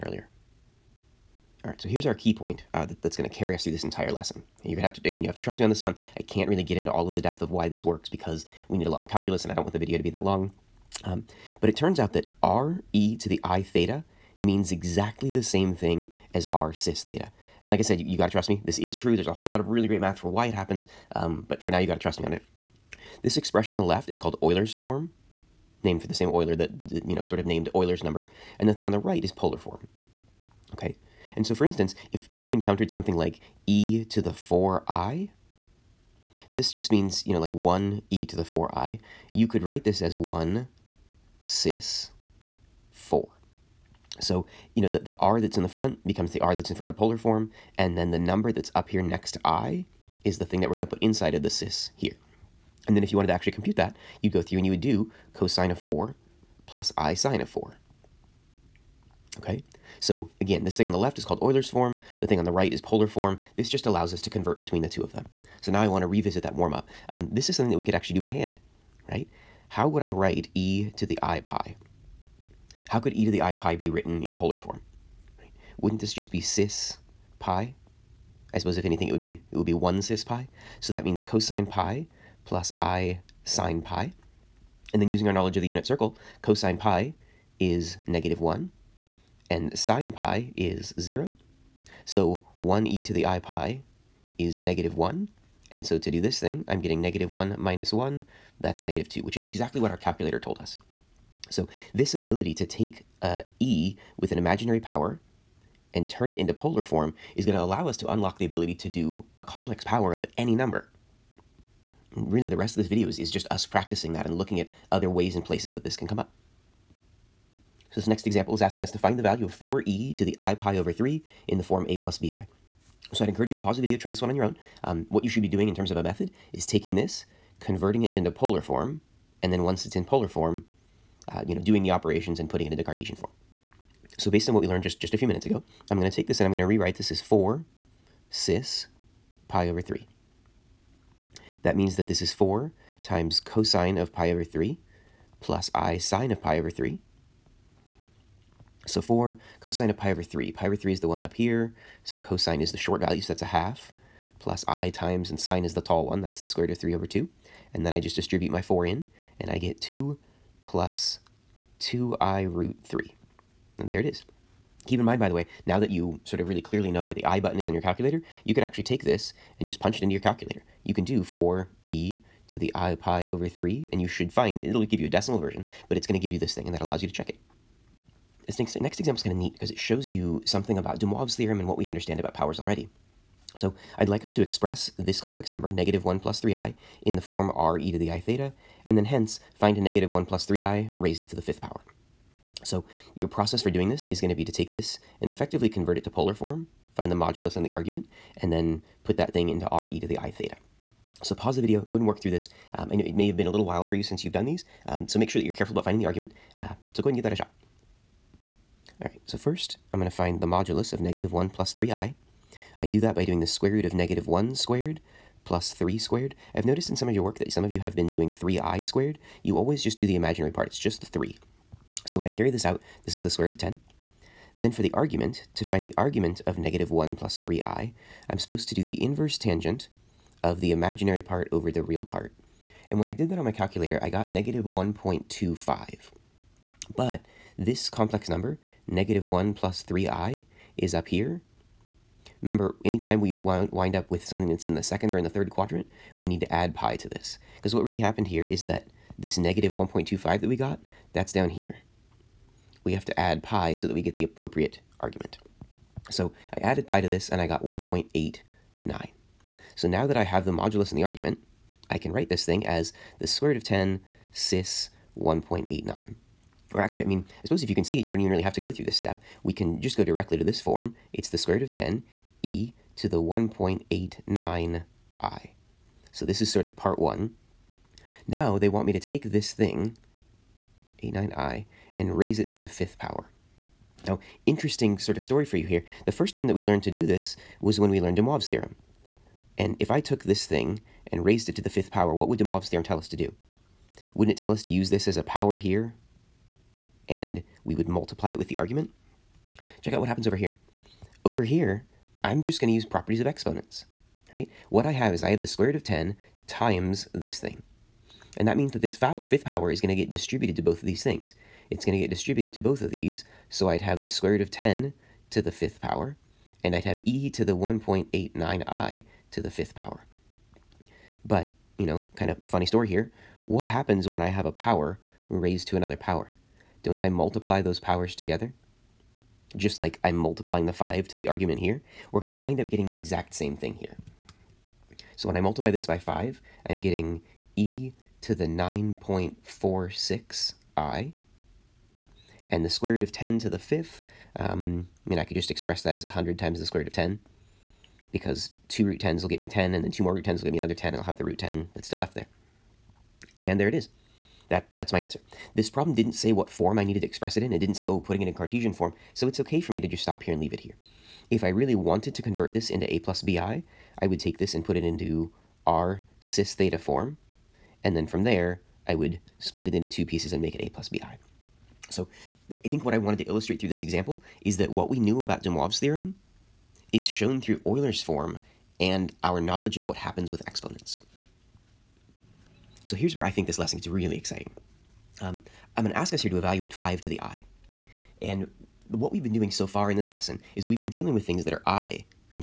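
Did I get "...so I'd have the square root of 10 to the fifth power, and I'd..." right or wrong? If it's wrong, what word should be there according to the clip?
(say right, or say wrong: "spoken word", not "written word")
right.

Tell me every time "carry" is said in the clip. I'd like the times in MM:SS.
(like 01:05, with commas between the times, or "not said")
00:03, 03:42.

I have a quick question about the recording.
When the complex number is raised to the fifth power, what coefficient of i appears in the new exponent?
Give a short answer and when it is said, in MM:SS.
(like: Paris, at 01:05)
9.46, at 05:38.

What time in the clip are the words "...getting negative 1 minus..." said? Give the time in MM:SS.
01:36.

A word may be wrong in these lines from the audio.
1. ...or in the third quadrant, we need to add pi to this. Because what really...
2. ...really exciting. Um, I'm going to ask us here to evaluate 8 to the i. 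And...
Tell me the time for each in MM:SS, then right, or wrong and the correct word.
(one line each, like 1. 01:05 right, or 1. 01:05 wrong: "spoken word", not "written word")
1. 04:05 right
2. 06:23 wrong: "5", not "8".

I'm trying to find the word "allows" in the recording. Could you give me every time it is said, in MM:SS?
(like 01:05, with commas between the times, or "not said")
01:03, 01:47, 02:56.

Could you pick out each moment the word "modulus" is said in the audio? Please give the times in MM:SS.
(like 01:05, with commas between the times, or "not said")
03:17, 03:30, 04:20.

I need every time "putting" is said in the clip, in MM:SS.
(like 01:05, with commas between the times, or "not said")
02:12, 05:57.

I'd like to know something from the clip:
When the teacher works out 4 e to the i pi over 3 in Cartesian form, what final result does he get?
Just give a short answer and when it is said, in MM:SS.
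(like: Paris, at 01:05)
2 plus 2i root 3, at 02:39.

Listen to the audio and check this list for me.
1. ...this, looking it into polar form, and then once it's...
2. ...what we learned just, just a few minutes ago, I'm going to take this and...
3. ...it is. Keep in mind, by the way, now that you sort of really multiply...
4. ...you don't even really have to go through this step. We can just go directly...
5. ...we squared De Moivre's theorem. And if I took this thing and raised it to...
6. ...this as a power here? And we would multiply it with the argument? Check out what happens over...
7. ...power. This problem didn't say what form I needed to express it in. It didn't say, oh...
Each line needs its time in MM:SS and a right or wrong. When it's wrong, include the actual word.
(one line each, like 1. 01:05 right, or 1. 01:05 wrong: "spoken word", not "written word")
1. 02:06 wrong: "converting", not "looking"
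2. 02:14 right
3. 02:43 wrong: "clearly", not "multiply"
4. 04:28 right
5. 04:47 wrong: "learned", not "squared"
6. 04:54 right
7. 05:54 wrong: "answer", not "power".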